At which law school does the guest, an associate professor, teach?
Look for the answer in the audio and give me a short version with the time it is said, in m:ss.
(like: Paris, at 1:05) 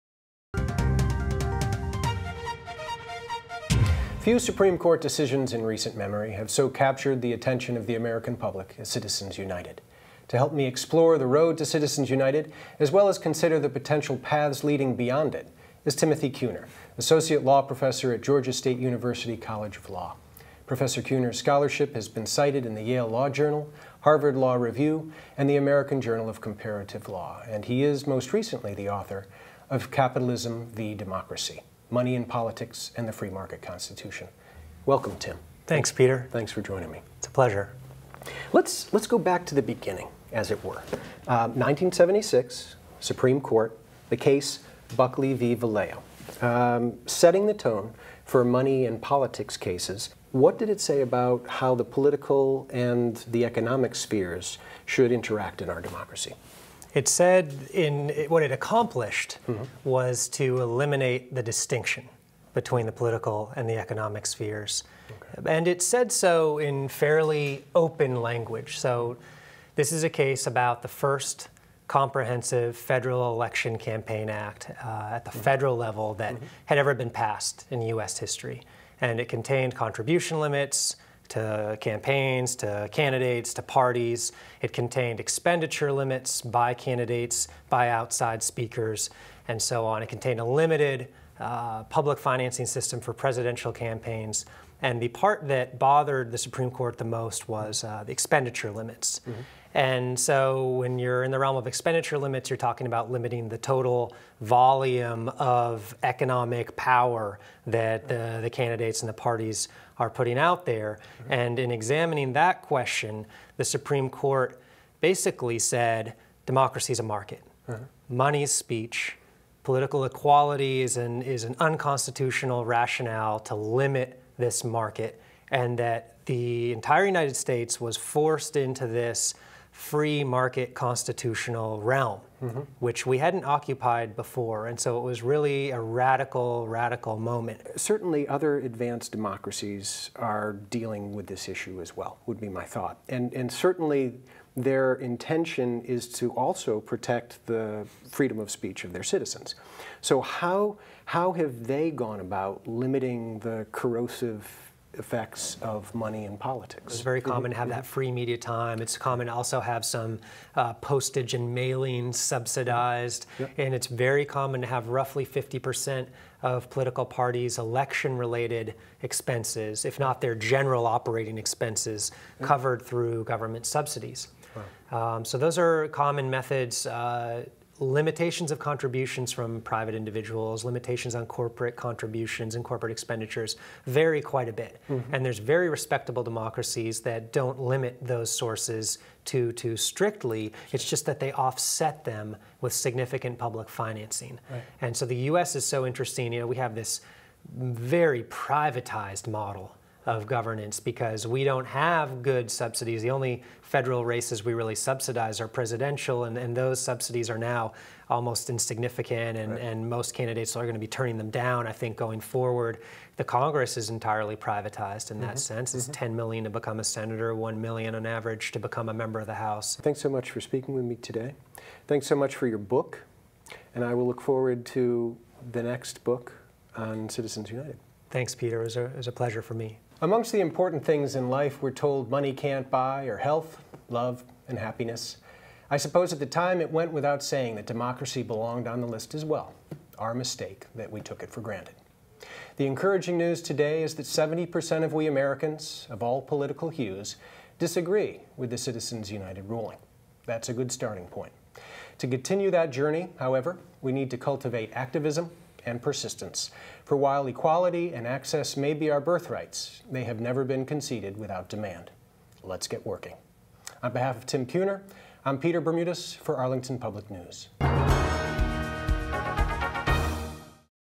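Georgia State University College of Law, at 0:18.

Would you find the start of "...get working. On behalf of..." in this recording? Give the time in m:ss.
4:22.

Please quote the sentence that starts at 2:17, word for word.
Certainly, other advanced democracies are dealing with this issue as well, would be my thought.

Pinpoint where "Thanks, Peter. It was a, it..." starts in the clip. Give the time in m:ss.
3:48.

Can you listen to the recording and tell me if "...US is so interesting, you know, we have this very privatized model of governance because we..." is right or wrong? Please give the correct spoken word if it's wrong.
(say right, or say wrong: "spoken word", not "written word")
right.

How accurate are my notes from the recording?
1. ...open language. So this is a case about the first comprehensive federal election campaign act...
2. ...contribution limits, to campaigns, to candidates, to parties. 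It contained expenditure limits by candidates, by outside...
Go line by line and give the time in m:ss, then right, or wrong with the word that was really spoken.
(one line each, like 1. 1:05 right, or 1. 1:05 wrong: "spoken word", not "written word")
1. 1:07 right
2. 1:19 right.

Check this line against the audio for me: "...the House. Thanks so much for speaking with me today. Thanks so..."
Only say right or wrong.
right.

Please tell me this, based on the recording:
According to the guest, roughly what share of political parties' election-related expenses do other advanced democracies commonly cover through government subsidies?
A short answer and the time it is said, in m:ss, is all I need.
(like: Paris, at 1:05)
50%, at 2:45.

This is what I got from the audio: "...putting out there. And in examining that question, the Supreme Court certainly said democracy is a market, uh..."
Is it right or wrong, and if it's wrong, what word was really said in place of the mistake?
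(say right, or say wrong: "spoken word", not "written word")
wrong: "basically", not "certainly".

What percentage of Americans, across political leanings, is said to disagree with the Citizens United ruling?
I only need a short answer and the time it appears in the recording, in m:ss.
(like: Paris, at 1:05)
70%, at 4:04.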